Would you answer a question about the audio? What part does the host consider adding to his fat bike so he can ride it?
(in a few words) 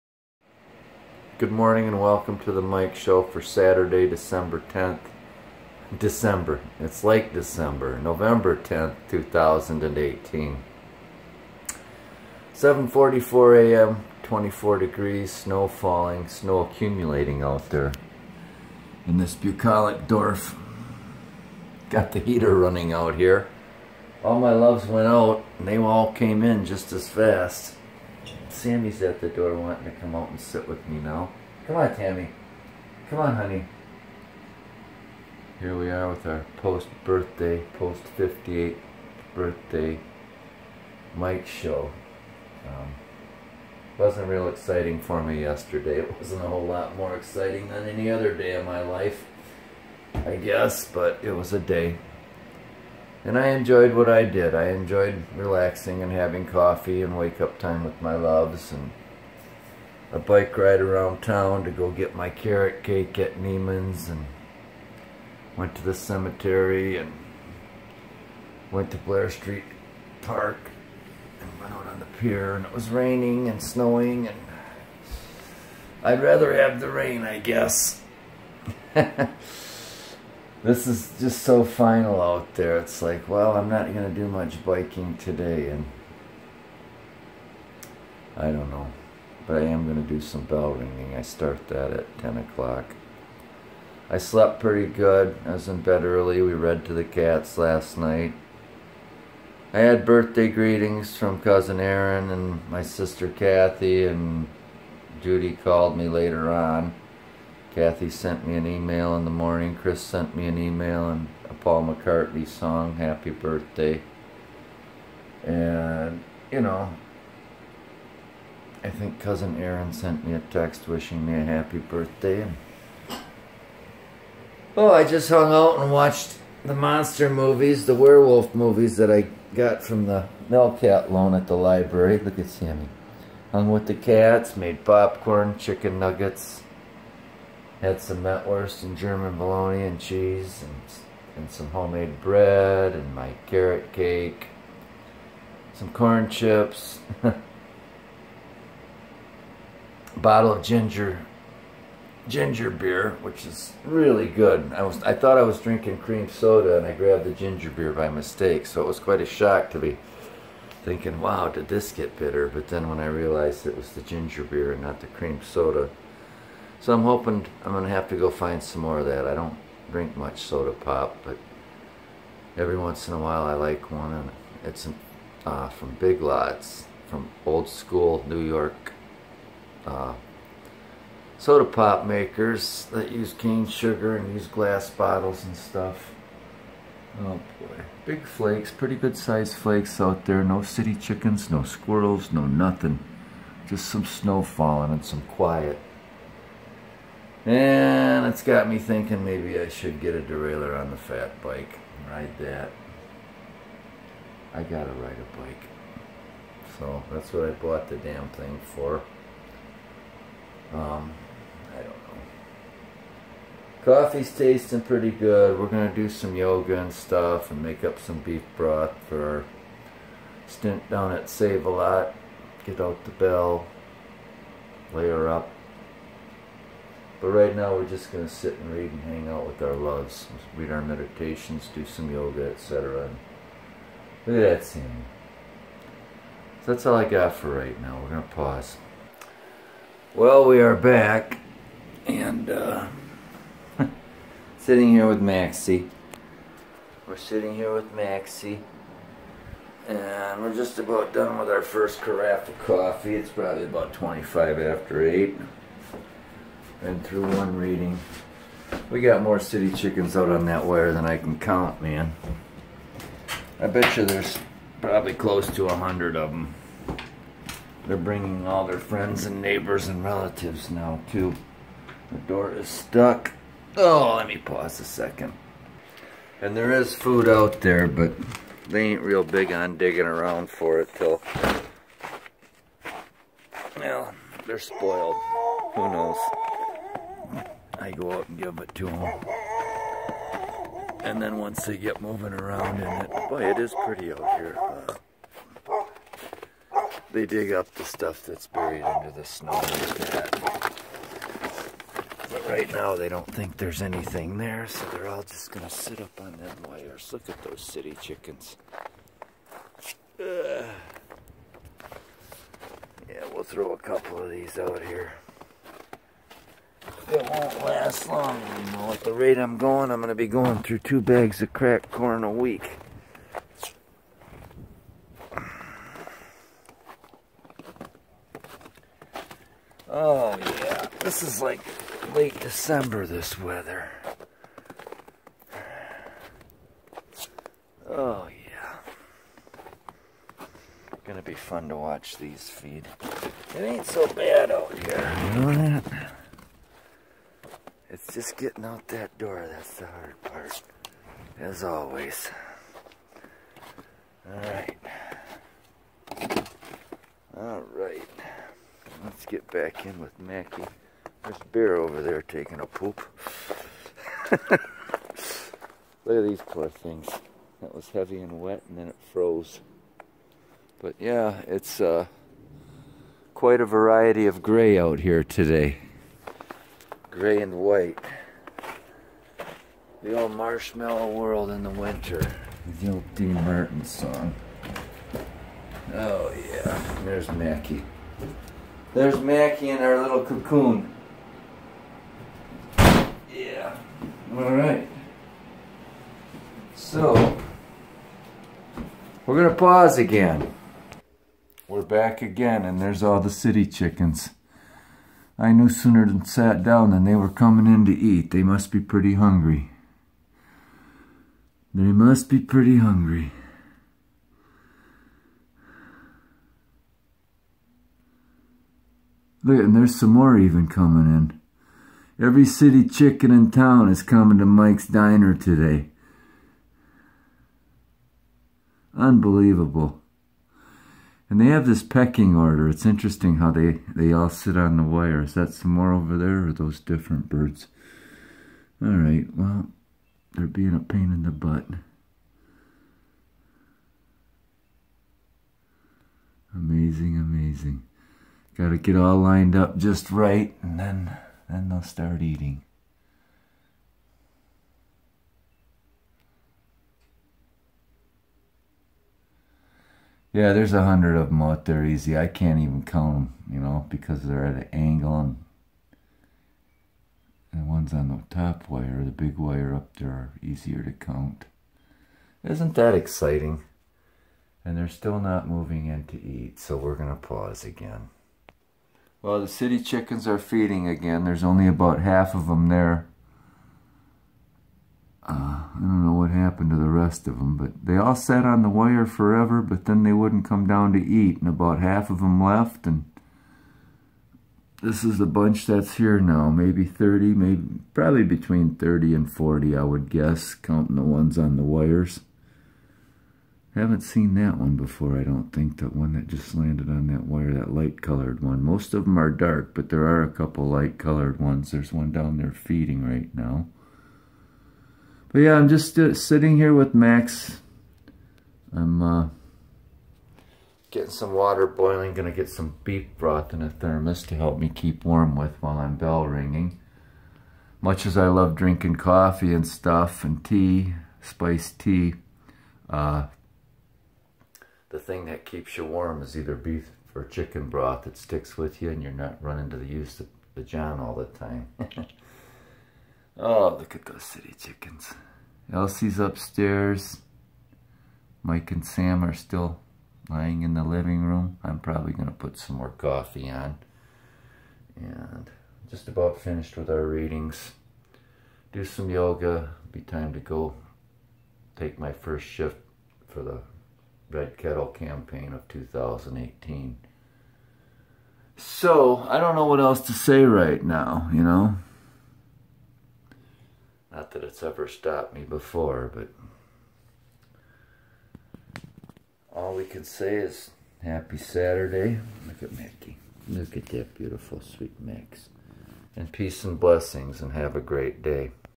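Derailleur.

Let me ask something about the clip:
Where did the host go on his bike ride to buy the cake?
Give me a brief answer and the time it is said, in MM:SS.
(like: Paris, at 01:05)
Neiman's, at 01:03.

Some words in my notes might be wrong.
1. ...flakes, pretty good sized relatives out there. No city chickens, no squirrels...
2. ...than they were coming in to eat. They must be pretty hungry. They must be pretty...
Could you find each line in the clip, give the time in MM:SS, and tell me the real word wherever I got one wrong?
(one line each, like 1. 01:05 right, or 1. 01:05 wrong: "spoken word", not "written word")
1. 03:08 wrong: "flakes", not "relatives"
2. 06:46 right.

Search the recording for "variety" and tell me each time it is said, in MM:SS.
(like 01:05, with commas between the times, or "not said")
06:13.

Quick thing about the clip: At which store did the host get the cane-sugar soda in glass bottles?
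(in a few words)
Big Lots.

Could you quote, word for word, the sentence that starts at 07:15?
Is that some more over there or those different birds?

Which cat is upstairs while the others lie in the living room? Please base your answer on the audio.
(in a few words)
Elsie.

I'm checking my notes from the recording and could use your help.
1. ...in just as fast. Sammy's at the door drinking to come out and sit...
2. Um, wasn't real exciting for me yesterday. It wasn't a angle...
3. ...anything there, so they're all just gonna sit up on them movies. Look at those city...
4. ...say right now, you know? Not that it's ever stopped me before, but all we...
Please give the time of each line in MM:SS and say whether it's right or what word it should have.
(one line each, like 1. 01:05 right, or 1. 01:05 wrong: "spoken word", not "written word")
1. 00:26 wrong: "wanting", not "drinking"
2. 00:42 wrong: "whole", not "angle"
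3. 05:03 wrong: "wires", not "movies"
4. 09:30 right.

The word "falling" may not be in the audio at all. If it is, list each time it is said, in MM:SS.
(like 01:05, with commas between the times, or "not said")
00:15, 03:14.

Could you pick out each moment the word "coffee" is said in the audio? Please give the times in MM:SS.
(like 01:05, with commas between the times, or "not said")
00:56, 03:33, 04:12, 08:48, 09:12.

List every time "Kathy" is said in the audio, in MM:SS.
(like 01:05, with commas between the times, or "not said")
01:43, 01:47.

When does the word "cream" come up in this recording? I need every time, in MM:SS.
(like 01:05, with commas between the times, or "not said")
02:35, 02:45.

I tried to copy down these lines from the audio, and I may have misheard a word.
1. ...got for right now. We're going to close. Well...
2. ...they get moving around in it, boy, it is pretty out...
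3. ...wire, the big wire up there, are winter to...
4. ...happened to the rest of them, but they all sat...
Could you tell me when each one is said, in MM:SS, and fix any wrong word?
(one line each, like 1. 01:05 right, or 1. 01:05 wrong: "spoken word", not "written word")
1. 03:57 wrong: "pause", not "close"
2. 04:51 right
3. 07:48 wrong: "easier", not "winter"
4. 08:06 right.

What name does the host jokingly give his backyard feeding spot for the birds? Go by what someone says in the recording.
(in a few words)
Mike's Diner.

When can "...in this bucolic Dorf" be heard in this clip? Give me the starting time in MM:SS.
00:19.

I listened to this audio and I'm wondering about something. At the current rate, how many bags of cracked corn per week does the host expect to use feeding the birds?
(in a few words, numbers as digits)
2.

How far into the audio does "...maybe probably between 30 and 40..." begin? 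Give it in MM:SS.
08:17.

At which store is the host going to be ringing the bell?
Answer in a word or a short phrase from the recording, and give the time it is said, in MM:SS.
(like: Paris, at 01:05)
Save-A-Lot, at 03:41.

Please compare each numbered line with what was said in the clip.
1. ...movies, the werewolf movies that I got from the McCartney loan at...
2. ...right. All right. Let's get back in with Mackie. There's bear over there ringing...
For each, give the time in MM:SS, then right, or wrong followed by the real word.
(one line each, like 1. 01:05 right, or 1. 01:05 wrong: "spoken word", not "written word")
1. 02:07 wrong: "Melcat", not "McCartney"
2. 05:54 wrong: "taking", not "ringing".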